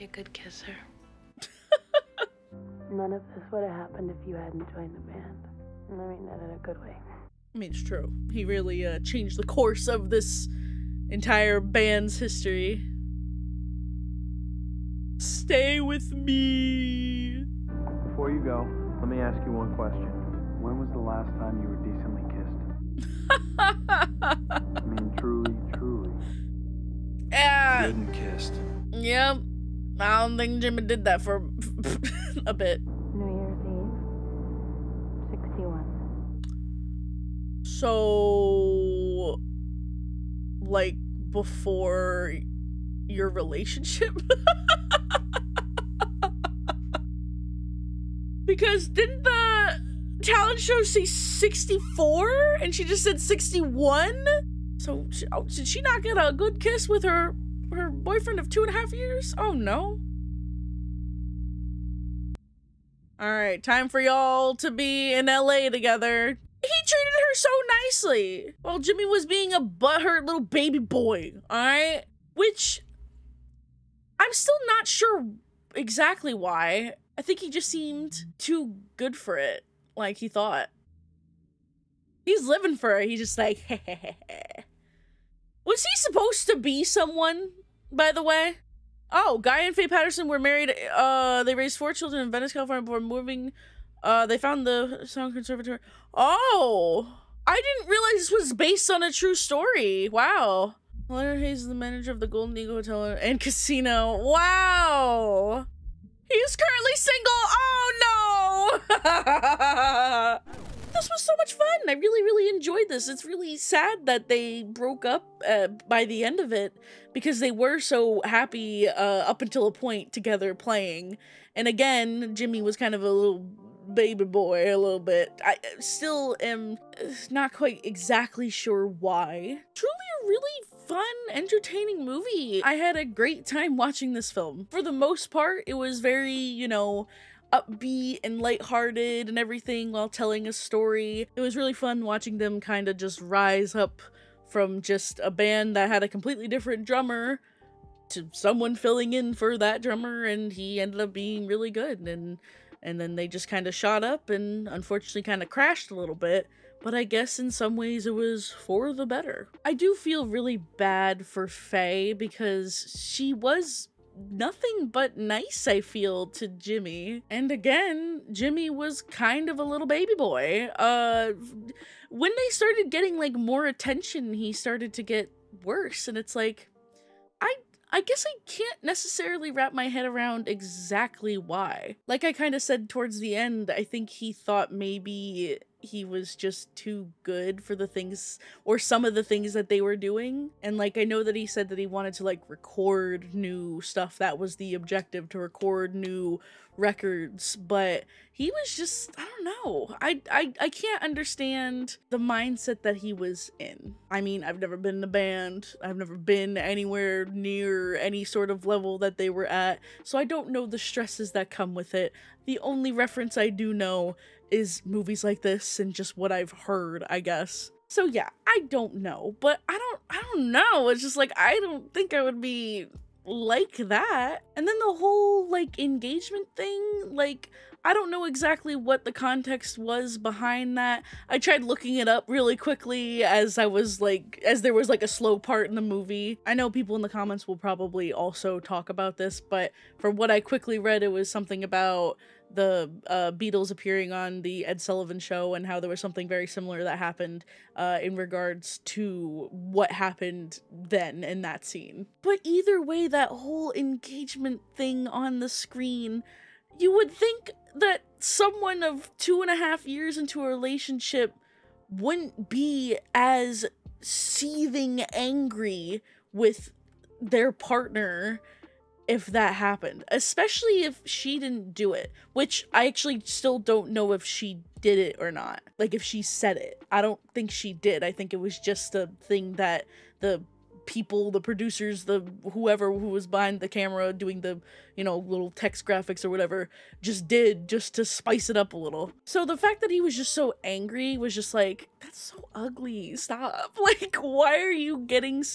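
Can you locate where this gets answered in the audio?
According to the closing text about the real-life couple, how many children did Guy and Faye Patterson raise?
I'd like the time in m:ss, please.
1:31.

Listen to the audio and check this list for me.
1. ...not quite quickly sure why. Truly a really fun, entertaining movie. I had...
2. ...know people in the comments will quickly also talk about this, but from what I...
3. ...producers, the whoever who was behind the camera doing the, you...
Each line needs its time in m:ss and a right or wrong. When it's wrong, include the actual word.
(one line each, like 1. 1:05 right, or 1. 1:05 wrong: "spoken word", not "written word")
1. 2:07 wrong: "exactly", not "quickly"
2. 3:56 wrong: "probably", not "quickly"
3. 4:41 right.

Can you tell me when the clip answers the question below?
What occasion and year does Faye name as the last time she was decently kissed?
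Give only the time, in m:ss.
0:33.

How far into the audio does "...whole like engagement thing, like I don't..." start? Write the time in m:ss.
3:44.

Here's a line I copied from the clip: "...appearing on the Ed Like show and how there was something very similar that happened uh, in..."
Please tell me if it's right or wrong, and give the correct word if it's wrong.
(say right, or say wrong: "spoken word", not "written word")
wrong: "Sullivan", not "Like".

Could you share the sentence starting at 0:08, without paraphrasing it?
He really uh, changed the course of this entire band's history.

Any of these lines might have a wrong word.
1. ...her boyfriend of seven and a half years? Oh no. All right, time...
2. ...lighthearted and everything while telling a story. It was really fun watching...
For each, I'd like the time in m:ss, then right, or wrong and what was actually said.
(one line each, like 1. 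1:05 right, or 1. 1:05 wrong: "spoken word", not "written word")
1. 0:57 wrong: "two", not "seven"
2. 2:18 right.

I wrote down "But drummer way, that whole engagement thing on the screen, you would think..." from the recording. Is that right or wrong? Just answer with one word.
wrong.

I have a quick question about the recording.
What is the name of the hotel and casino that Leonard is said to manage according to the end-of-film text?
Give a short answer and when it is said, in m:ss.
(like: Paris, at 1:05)
Golden Eagle Hotel and Casino, at 1:42.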